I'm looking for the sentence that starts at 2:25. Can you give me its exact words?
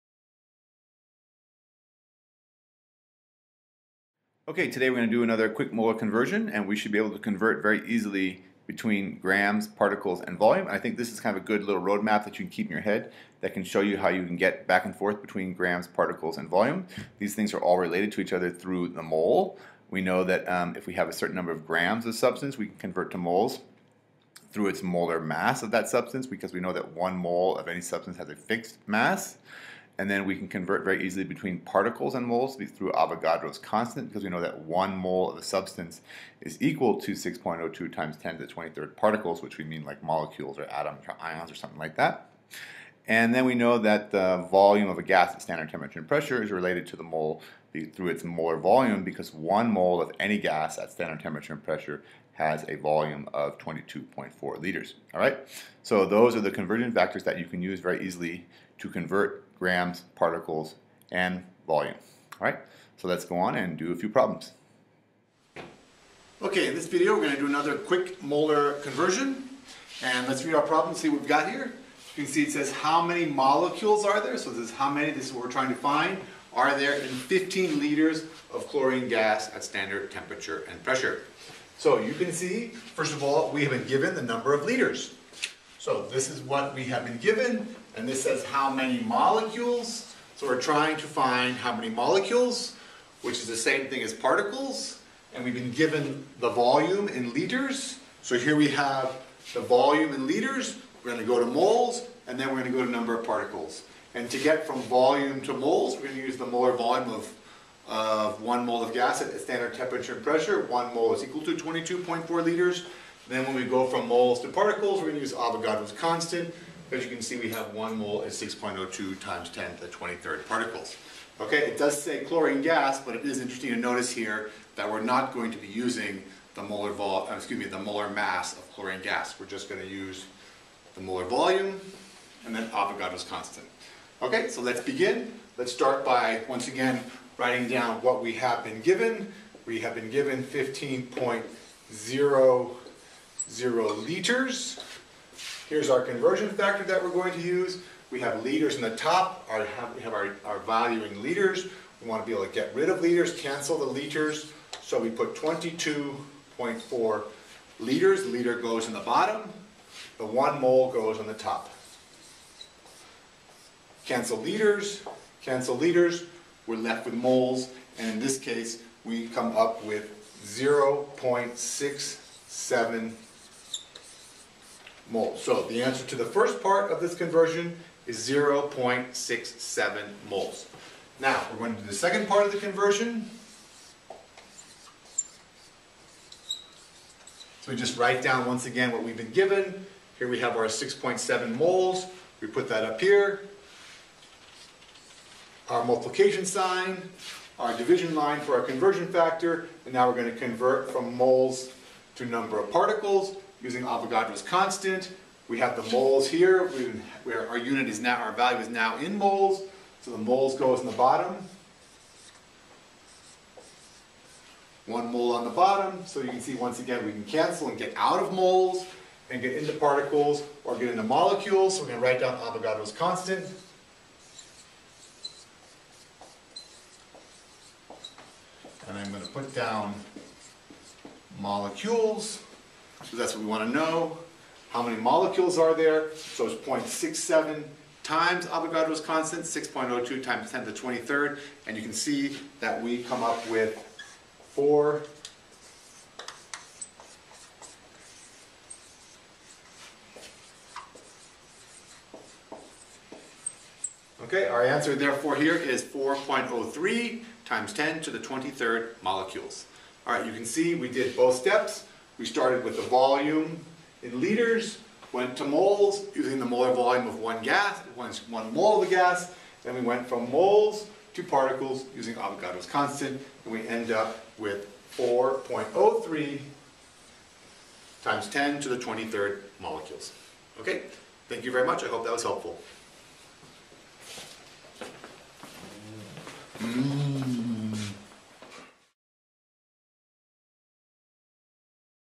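Here's our conversion factor that we're going to use.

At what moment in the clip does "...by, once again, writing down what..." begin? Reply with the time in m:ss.
2:16.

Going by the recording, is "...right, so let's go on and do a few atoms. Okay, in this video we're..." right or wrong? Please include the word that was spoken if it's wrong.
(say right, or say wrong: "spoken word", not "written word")
wrong: "problems", not "atoms".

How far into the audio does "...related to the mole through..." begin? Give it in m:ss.
0:46.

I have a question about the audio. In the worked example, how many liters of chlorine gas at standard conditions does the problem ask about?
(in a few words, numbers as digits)
15 liters.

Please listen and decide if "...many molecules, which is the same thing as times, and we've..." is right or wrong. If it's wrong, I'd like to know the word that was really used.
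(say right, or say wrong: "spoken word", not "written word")
wrong: "particles", not "times".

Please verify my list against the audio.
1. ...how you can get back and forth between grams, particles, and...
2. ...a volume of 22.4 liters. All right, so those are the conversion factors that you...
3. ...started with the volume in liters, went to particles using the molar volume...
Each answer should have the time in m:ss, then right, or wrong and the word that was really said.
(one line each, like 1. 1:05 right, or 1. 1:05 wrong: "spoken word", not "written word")
1. 0:13 right
2. 0:52 right
3. 4:22 wrong: "moles", not "particles".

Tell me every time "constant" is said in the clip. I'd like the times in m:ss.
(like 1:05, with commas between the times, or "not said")
0:33, 1:55, 2:13, 3:24, 3:42, 3:59, 4:32.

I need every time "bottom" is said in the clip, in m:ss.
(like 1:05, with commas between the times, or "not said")
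2:38, 3:30, 3:35.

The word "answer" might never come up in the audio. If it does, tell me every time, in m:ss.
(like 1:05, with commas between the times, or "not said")
2:55, 4:14.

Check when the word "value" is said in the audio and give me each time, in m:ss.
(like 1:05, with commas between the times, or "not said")
2:30, 3:28.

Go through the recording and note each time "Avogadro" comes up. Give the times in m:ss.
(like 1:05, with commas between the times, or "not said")
0:32, 1:55, 2:12, 3:23, 3:42, 3:58, 4:32.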